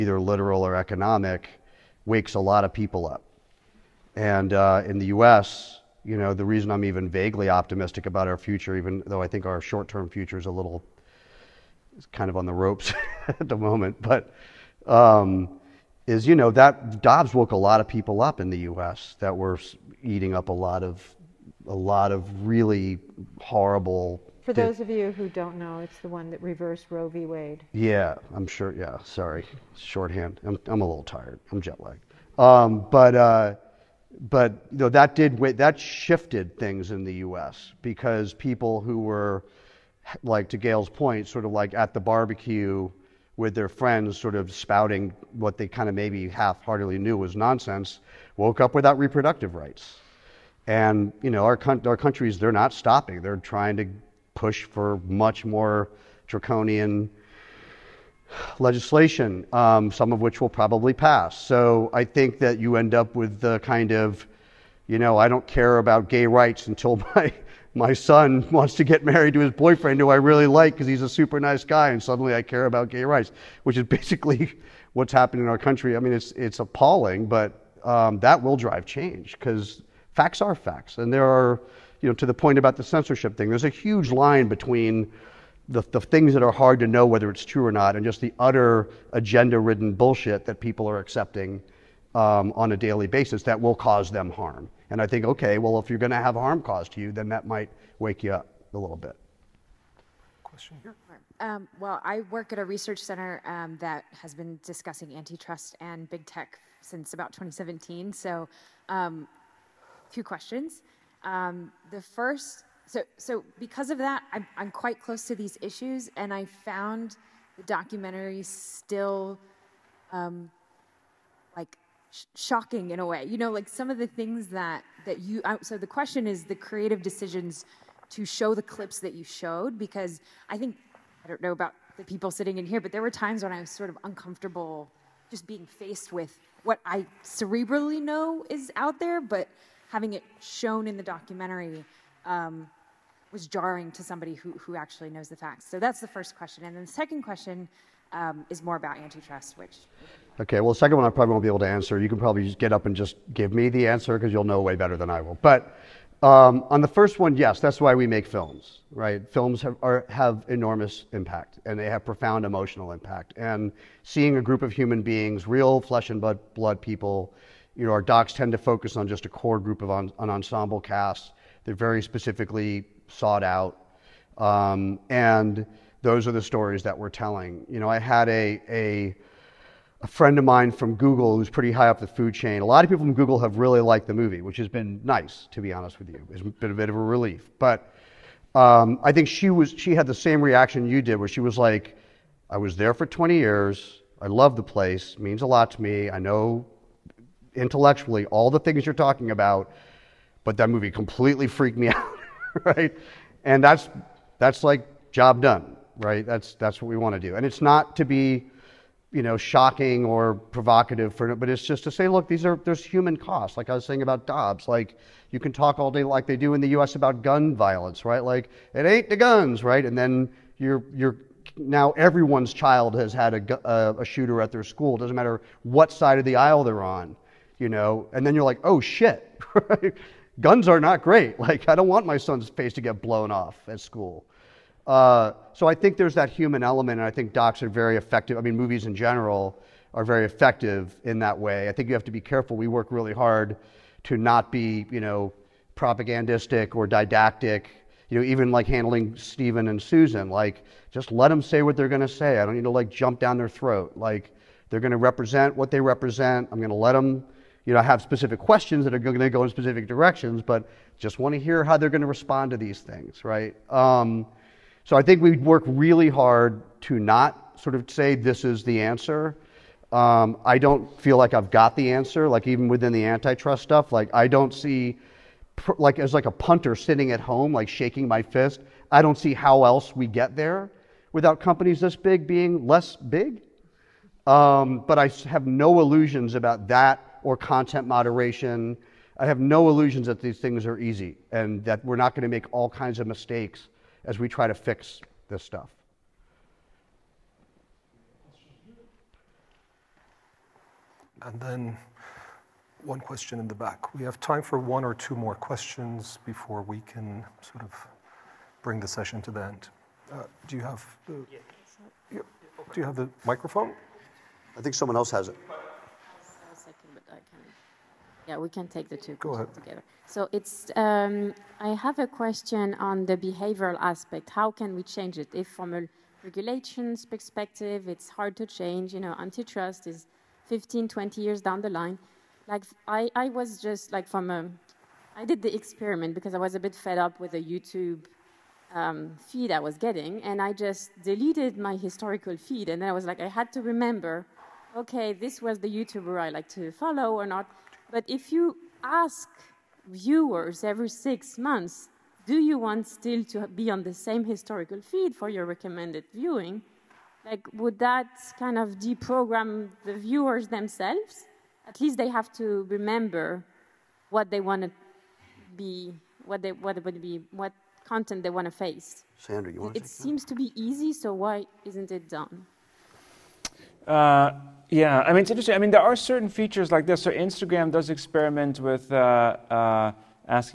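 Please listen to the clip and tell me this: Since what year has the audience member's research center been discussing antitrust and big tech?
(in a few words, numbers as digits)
2017.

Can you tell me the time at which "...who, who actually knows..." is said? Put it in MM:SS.
02:24.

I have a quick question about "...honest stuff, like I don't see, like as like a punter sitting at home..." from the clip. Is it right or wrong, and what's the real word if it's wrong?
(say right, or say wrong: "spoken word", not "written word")
wrong: "antitrust", not "honest".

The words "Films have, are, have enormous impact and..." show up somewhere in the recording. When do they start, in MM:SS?
02:39.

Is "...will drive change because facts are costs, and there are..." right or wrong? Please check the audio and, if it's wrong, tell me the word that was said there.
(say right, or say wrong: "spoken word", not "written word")
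wrong: "facts", not "costs".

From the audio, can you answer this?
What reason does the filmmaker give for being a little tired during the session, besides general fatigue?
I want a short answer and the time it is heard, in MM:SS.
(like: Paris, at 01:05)
Jet lagged, at 00:31.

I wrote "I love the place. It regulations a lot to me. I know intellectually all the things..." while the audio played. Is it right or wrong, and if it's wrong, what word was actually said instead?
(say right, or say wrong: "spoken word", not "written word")
wrong: "means", not "regulations".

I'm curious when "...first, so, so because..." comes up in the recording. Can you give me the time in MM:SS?
01:52.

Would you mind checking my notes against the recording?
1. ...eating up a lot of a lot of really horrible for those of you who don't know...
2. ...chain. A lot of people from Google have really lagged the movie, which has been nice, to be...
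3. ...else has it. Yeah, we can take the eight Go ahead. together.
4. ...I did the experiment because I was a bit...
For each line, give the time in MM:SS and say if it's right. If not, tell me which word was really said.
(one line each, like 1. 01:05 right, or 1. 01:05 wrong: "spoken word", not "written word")
1. 00:20 right
2. 03:02 wrong: "liked", not "lagged"
3. 05:14 wrong: "two", not "eight"
4. 05:35 right.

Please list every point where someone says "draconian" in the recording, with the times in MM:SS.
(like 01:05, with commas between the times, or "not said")
00:56.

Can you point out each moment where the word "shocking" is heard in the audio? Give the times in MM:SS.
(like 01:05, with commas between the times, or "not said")
02:02, 03:29.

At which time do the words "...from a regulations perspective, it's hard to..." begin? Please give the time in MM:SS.
05:25.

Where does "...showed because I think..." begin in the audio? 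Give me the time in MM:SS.
02:09.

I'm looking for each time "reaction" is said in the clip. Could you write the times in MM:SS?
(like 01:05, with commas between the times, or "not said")
03:10.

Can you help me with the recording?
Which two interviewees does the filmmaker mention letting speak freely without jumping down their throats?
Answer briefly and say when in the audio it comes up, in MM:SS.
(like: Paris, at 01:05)
Steven and Susan, at 04:09.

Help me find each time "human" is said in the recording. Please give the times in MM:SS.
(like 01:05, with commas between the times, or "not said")
02:44, 03:32, 03:56.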